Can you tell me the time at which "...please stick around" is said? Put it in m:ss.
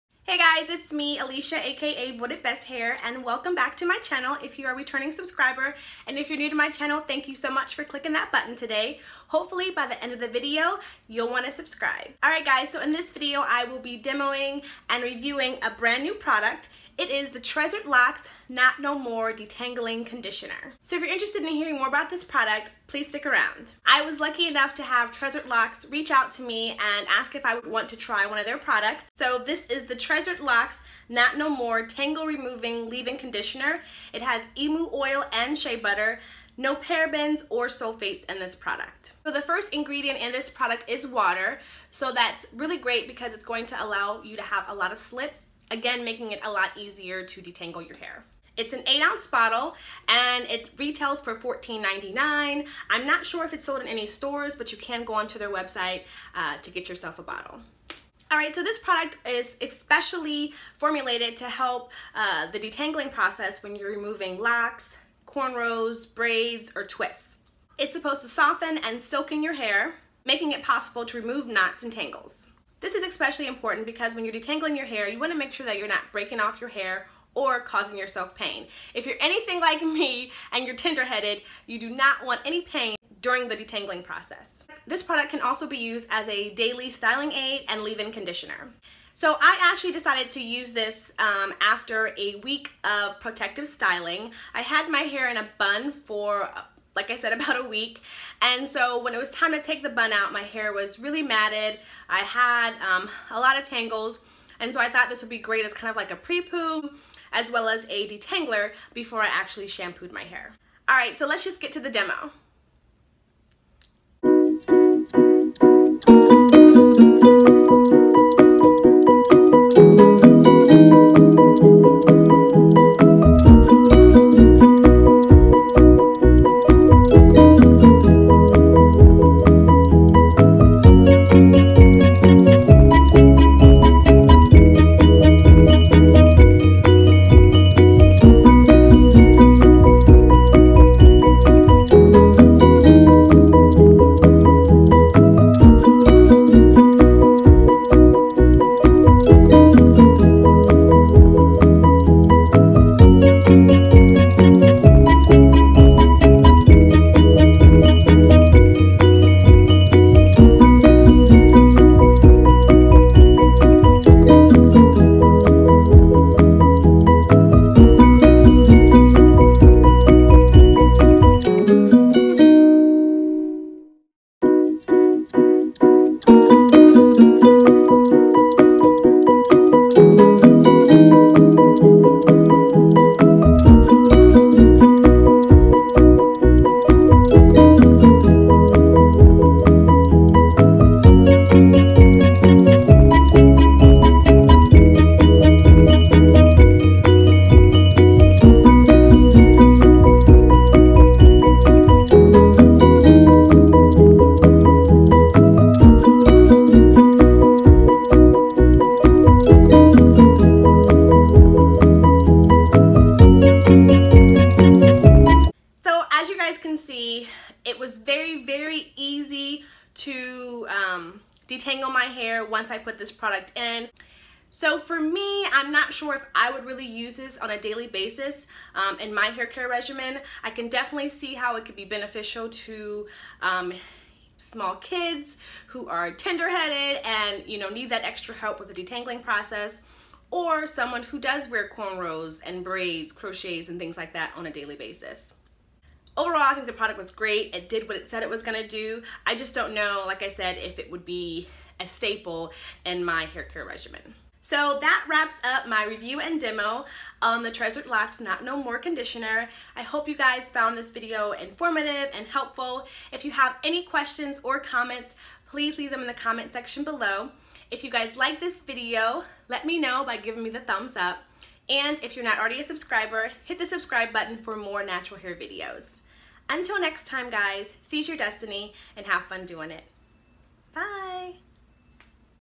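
0:22.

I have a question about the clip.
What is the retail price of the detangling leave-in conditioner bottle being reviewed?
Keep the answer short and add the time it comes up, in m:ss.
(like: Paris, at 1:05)
$14.99, at 0:51.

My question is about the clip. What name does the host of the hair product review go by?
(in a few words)
Voted Best Hair.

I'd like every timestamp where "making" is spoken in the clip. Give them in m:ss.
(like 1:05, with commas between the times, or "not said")
0:46, 1:10.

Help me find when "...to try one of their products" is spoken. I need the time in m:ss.
0:27.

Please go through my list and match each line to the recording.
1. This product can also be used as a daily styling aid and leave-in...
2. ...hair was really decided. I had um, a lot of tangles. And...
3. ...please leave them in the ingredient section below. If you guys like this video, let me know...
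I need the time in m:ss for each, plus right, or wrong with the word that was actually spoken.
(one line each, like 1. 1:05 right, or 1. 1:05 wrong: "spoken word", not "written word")
1. 1:24 right
2. 1:40 wrong: "matted", not "decided"
3. 4:25 wrong: "comment", not "ingredient".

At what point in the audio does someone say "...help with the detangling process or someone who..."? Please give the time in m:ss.
3:58.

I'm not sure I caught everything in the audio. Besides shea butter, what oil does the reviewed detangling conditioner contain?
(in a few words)
emu oil.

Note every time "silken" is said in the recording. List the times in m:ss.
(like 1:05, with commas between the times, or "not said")
1:09.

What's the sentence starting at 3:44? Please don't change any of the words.
So for me, I'm not sure if I would really use this on a daily basis um, in my hair care regimen.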